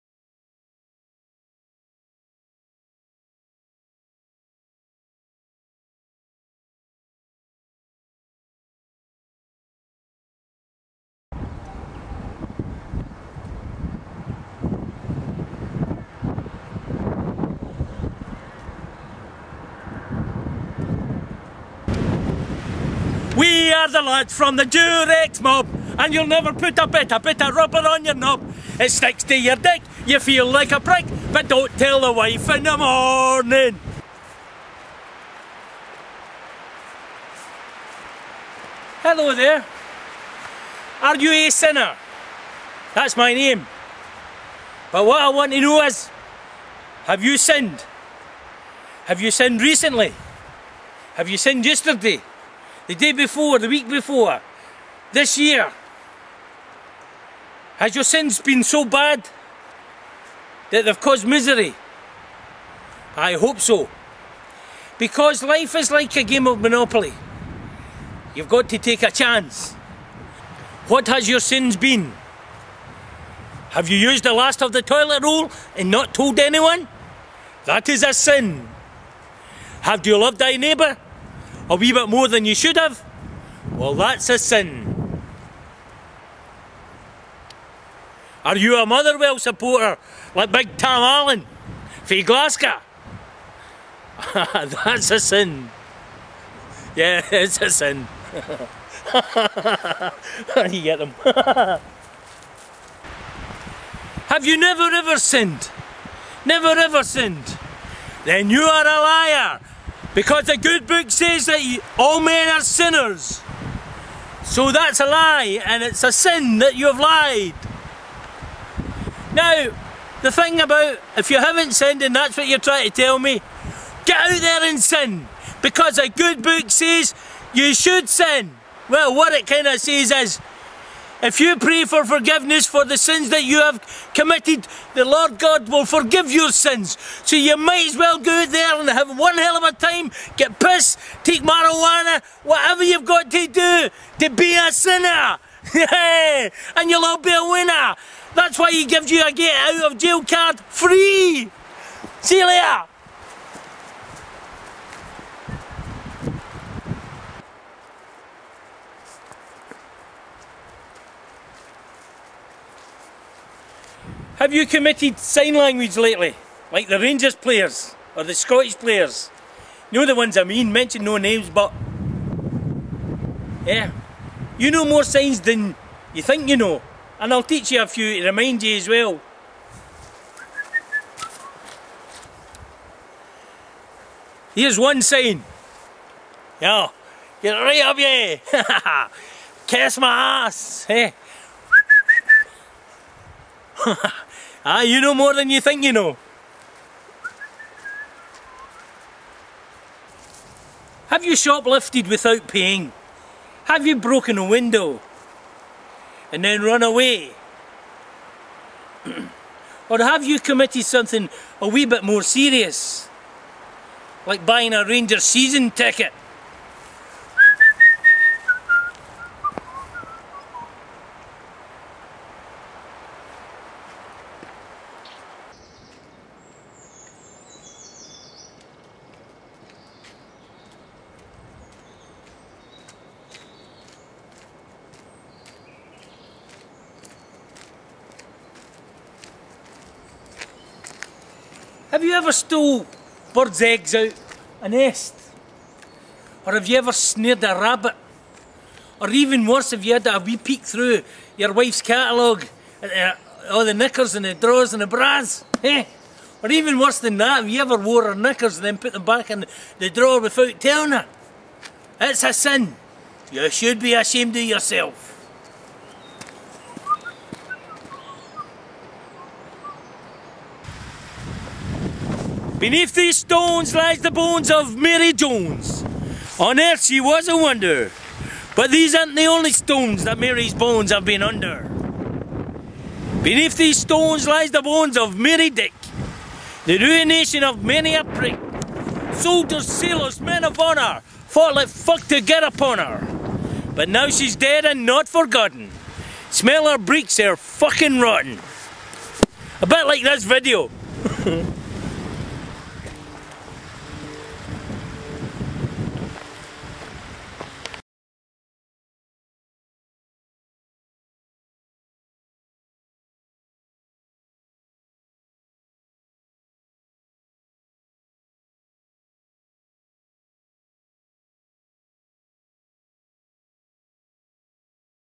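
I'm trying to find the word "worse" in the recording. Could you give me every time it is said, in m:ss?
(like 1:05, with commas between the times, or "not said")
4:09, 4:16.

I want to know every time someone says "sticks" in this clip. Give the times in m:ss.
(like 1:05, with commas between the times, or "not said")
0:28.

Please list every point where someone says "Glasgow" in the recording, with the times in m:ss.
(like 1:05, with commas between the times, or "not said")
1:32.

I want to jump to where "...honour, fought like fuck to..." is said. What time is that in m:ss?
4:50.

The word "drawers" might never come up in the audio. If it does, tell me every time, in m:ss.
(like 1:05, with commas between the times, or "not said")
4:14, 4:19.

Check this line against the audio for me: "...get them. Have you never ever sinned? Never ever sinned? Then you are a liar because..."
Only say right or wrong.
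right.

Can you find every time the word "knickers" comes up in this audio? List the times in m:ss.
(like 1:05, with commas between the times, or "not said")
4:13, 4:18.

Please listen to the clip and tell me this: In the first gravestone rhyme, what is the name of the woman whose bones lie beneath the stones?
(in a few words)
Mary Jones.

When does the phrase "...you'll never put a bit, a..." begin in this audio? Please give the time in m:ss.
0:26.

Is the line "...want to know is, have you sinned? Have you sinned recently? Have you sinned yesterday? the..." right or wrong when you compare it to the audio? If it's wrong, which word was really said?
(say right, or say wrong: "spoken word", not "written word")
right.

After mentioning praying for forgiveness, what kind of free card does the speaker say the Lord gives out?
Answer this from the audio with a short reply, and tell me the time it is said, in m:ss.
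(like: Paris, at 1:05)
get out of jail card, at 2:29.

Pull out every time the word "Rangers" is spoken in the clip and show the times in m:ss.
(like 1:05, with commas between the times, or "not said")
2:46, 3:34.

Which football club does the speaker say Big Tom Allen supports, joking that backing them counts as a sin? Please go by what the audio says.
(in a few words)
Motherwell.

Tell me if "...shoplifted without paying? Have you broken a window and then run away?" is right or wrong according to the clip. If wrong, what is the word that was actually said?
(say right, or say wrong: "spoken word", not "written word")
right.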